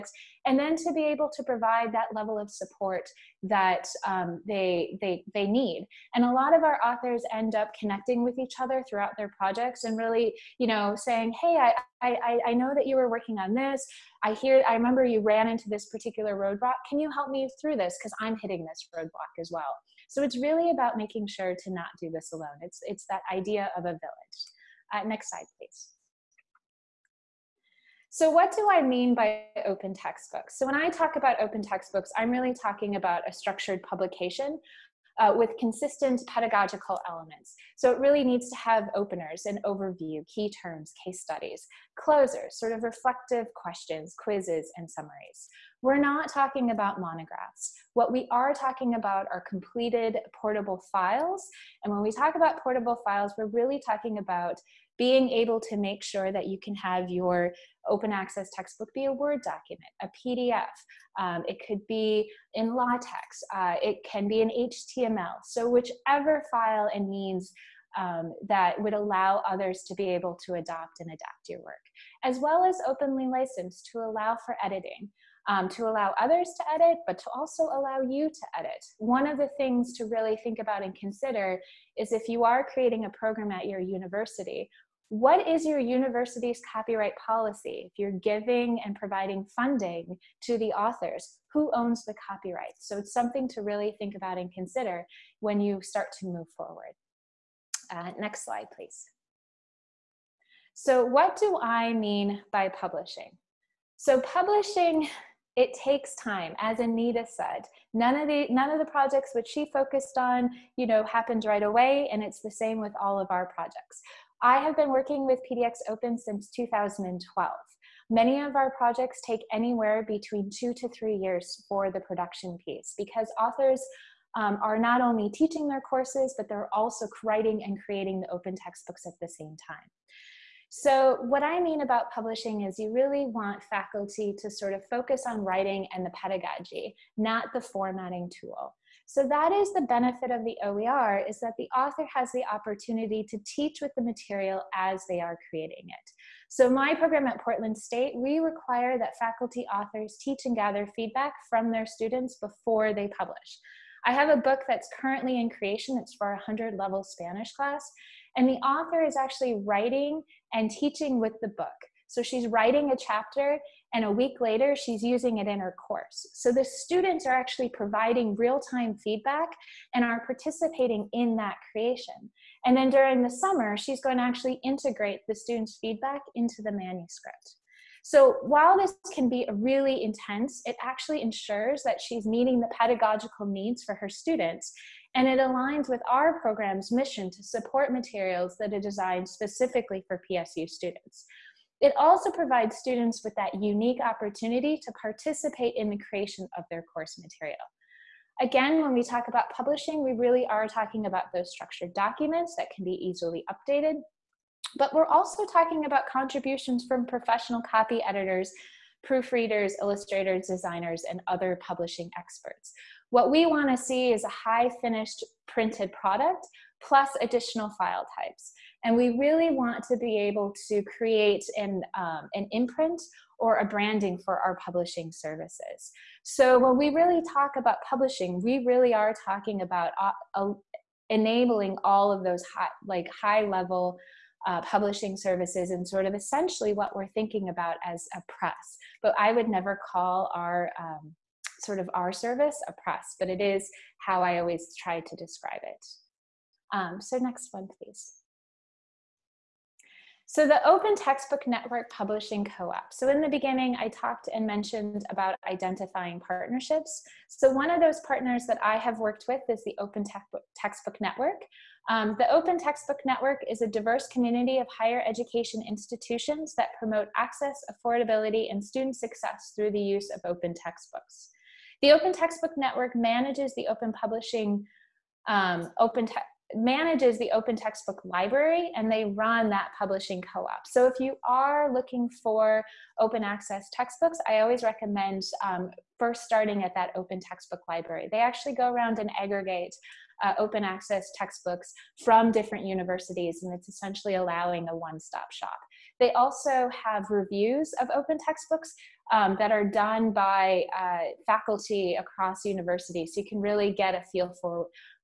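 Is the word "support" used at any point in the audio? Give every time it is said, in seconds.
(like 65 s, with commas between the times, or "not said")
2 s, 187 s.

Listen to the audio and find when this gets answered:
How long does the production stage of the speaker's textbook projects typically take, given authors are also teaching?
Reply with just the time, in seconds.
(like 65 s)
120 s.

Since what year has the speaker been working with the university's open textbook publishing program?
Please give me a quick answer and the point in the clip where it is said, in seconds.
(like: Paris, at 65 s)
2012, at 116 s.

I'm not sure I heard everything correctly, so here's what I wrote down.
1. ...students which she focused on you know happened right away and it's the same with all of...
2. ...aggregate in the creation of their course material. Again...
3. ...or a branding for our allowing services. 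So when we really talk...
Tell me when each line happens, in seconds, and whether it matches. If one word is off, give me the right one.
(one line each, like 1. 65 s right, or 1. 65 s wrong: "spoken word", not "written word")
1. 108 s wrong: "projects", not "students"
2. 195 s wrong: "participate", not "aggregate"
3. 223 s wrong: "publishing", not "allowing".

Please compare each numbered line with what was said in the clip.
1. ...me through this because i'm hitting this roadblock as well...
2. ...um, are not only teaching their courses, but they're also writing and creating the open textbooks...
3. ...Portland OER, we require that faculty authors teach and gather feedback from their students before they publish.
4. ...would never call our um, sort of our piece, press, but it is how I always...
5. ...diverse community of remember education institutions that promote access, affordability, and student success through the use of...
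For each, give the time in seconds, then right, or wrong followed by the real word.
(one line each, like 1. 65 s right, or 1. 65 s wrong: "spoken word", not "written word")
1. 17 s right
2. 124 s right
3. 147 s wrong: "State", not "OER"
4. 239 s wrong: "service", not "piece"
5. 263 s wrong: "higher", not "remember".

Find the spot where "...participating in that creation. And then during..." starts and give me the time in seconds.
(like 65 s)
170 s.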